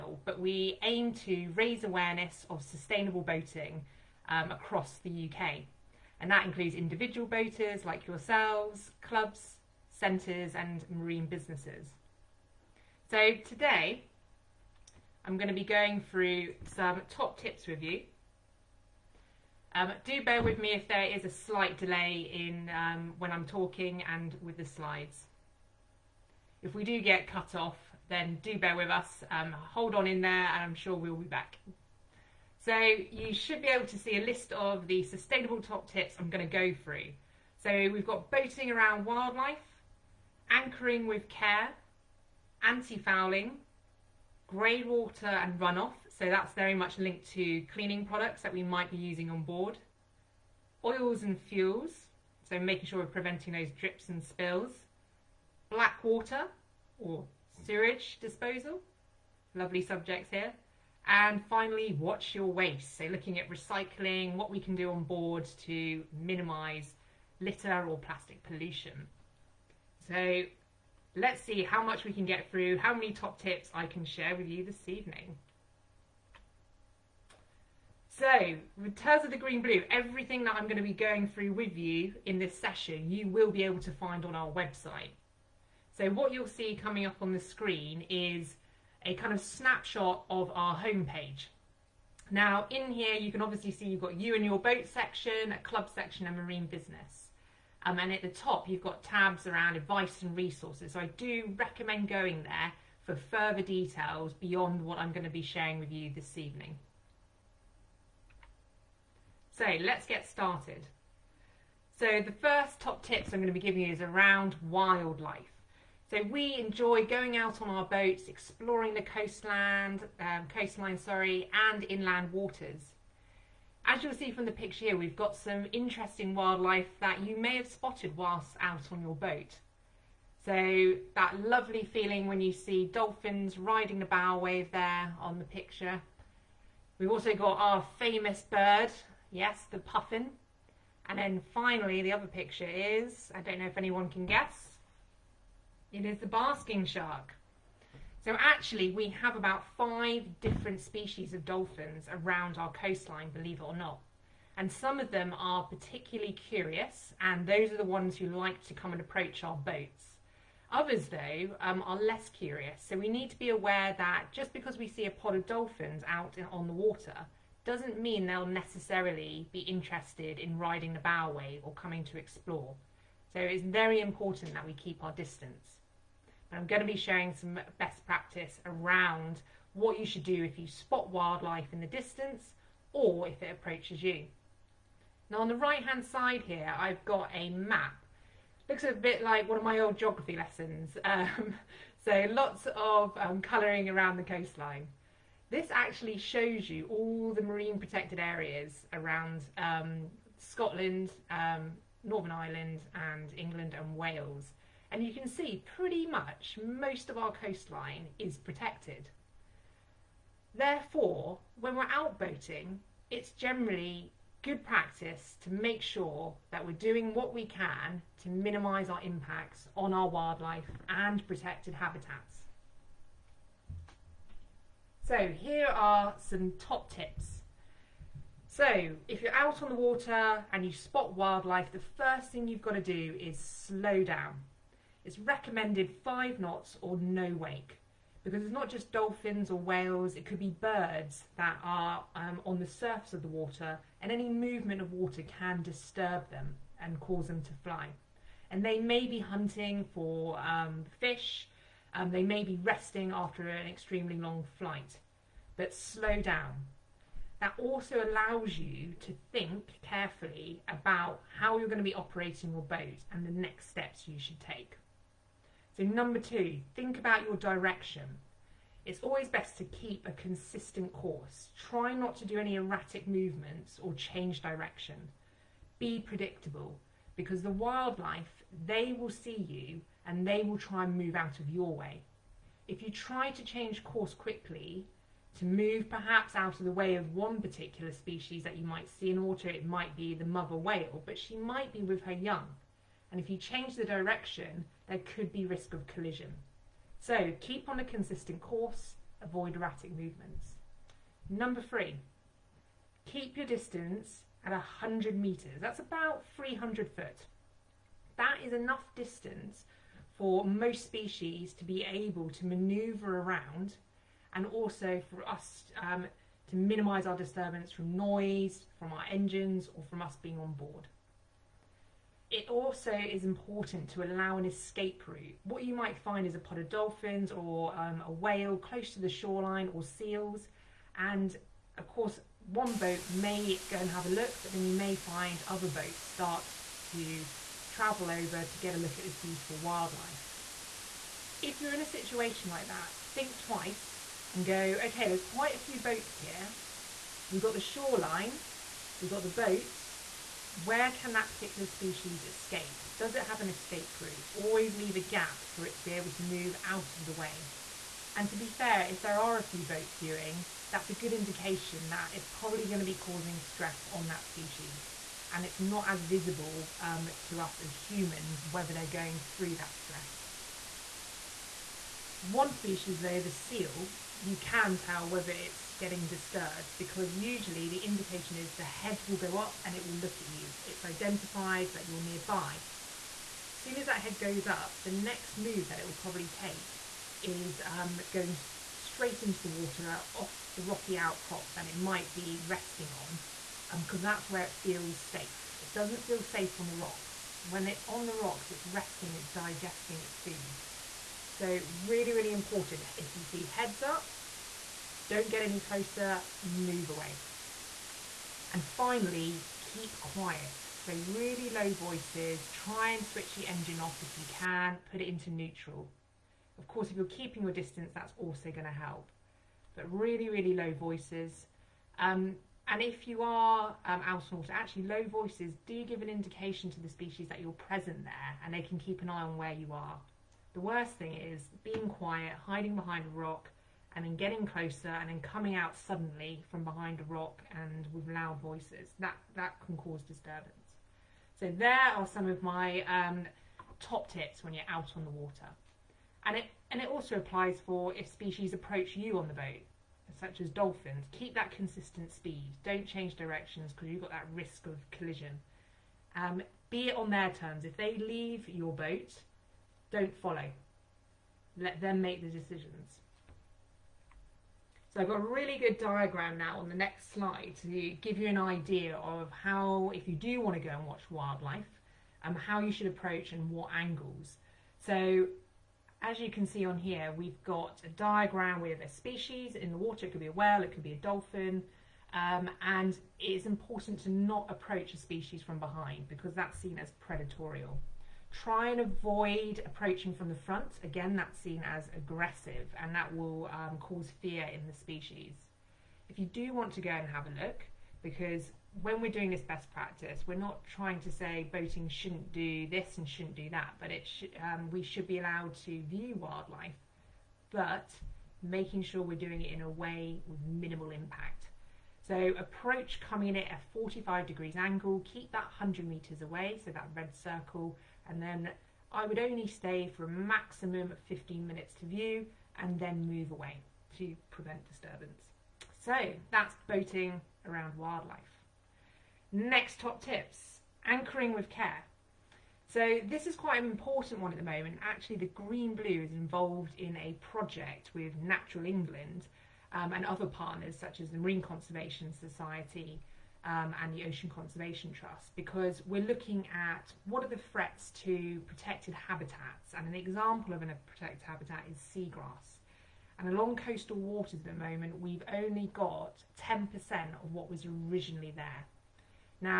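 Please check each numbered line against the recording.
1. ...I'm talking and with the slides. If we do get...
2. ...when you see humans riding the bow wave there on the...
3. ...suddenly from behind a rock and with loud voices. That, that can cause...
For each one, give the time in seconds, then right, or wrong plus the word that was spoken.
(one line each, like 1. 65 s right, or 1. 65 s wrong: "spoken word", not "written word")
1. 23 s right
2. 132 s wrong: "dolphins", not "humans"
3. 435 s right.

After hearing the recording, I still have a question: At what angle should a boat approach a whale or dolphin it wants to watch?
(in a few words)
45 degrees.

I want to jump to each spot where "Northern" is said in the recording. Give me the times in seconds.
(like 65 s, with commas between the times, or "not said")
202 s.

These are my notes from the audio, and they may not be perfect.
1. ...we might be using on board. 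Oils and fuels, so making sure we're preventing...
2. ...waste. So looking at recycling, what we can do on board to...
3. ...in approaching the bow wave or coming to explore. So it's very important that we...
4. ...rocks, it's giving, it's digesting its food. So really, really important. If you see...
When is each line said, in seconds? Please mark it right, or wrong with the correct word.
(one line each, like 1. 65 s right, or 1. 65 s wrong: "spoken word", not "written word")
1. 48 s right
2. 62 s right
3. 170 s wrong: "riding", not "approaching"
4. 398 s wrong: "resting", not "giving".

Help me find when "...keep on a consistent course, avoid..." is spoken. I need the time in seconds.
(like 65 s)
297 s.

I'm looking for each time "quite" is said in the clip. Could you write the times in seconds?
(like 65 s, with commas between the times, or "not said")
345 s, 533 s.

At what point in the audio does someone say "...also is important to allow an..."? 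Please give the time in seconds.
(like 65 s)
322 s.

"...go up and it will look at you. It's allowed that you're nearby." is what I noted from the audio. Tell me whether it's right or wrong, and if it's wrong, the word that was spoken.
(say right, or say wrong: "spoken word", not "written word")
wrong: "identified", not "allowed".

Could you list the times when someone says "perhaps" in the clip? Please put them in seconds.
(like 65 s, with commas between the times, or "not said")
285 s.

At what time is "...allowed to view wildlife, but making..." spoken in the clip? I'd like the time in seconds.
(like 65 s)
505 s.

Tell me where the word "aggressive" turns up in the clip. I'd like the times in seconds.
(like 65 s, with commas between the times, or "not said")
491 s.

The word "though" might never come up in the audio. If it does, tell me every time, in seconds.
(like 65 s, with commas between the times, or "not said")
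161 s, 373 s.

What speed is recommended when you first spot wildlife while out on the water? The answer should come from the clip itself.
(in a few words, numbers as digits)
5 knots.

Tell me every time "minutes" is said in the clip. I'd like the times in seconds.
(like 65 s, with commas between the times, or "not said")
521 s.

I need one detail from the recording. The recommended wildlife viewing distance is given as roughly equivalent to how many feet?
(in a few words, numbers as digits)
300 feet.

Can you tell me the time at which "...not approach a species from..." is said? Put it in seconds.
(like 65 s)
484 s.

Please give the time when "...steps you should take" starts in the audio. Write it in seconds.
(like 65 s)
263 s.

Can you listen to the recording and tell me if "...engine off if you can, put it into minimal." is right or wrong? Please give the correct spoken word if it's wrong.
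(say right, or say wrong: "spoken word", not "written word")
wrong: "neutral", not "minimal".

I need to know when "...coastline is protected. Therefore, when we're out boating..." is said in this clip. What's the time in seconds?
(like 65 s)
207 s.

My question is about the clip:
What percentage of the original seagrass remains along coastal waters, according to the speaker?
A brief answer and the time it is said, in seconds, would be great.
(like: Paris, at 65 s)
10%, at 556 s.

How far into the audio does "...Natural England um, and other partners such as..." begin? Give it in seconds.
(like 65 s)
538 s.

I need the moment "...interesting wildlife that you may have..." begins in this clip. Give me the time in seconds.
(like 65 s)
125 s.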